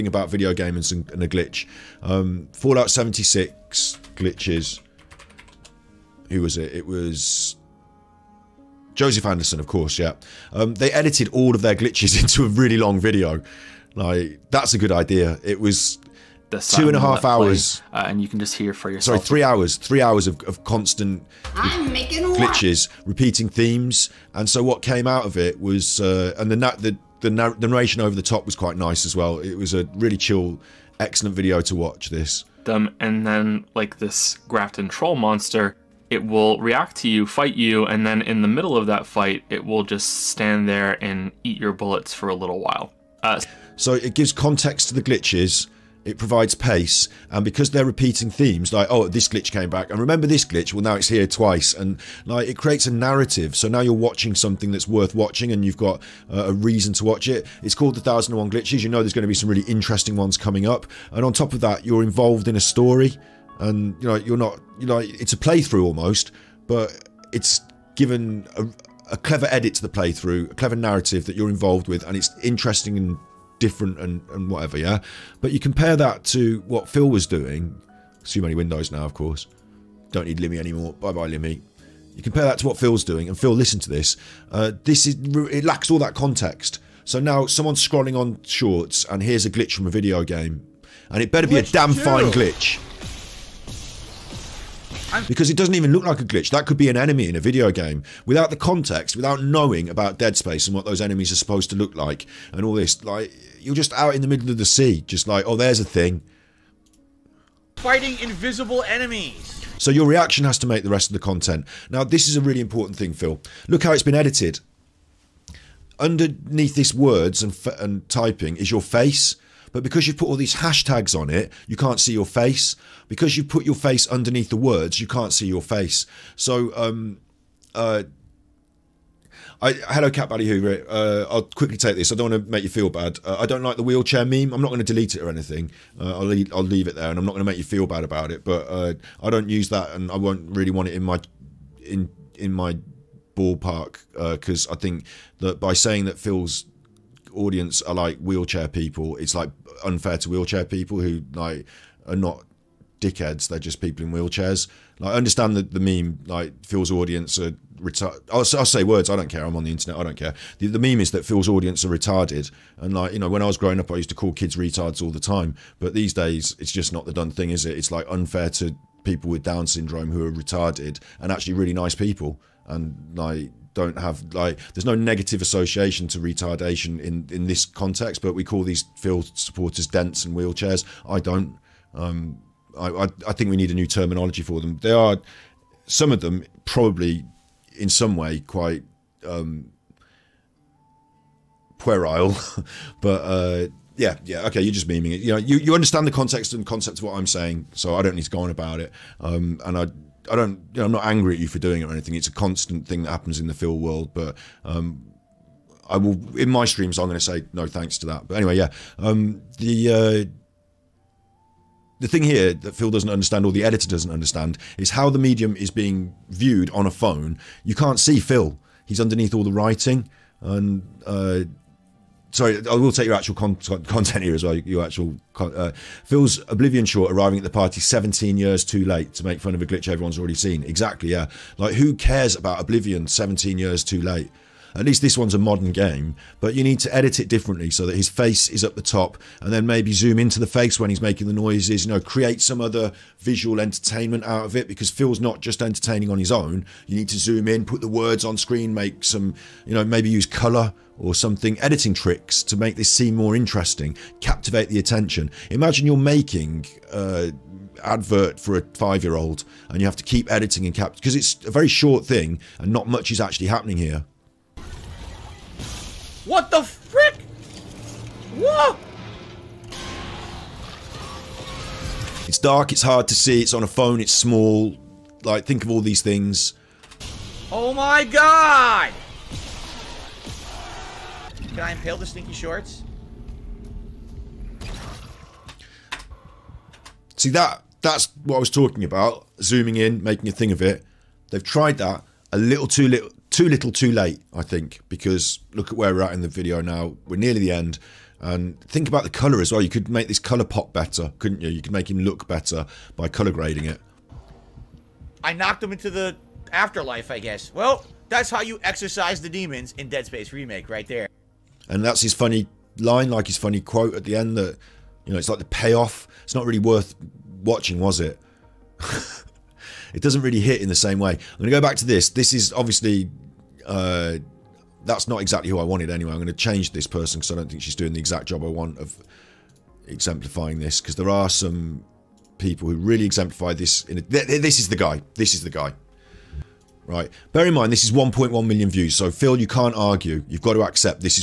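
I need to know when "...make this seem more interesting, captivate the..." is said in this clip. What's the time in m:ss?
4:12.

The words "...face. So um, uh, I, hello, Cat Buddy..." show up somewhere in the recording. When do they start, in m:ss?
2:05.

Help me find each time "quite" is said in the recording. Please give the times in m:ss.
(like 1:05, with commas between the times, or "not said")
0:28, 3:08.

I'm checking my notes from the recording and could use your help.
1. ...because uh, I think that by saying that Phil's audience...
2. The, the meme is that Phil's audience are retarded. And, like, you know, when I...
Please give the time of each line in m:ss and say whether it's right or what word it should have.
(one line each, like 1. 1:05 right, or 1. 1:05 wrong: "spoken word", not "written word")
1. 2:24 right
2. 2:40 right.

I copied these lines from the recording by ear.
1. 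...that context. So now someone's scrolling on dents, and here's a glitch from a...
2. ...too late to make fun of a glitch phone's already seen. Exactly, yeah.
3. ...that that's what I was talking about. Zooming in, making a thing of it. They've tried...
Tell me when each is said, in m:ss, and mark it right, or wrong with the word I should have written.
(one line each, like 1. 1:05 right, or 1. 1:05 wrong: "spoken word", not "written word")
1. 1:25 wrong: "shorts", not "dents"
2. 3:48 wrong: "everyone", not "phone"
3. 4:47 right.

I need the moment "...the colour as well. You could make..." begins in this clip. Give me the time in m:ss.
4:59.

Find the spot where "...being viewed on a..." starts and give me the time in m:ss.
3:35.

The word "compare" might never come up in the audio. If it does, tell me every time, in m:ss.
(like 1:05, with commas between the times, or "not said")
1:15, 1:22.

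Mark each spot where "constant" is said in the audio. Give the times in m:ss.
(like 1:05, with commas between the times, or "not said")
0:20, 3:22.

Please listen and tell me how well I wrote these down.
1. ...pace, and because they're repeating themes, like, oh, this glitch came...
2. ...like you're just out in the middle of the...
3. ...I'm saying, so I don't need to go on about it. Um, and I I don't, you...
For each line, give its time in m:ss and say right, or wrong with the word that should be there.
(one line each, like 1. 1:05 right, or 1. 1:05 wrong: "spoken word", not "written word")
1. 0:46 right
2. 1:43 right
3. 3:17 right.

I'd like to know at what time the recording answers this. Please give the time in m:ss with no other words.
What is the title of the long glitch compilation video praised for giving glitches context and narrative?
0:57.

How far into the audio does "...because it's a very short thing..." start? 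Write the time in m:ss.
4:20.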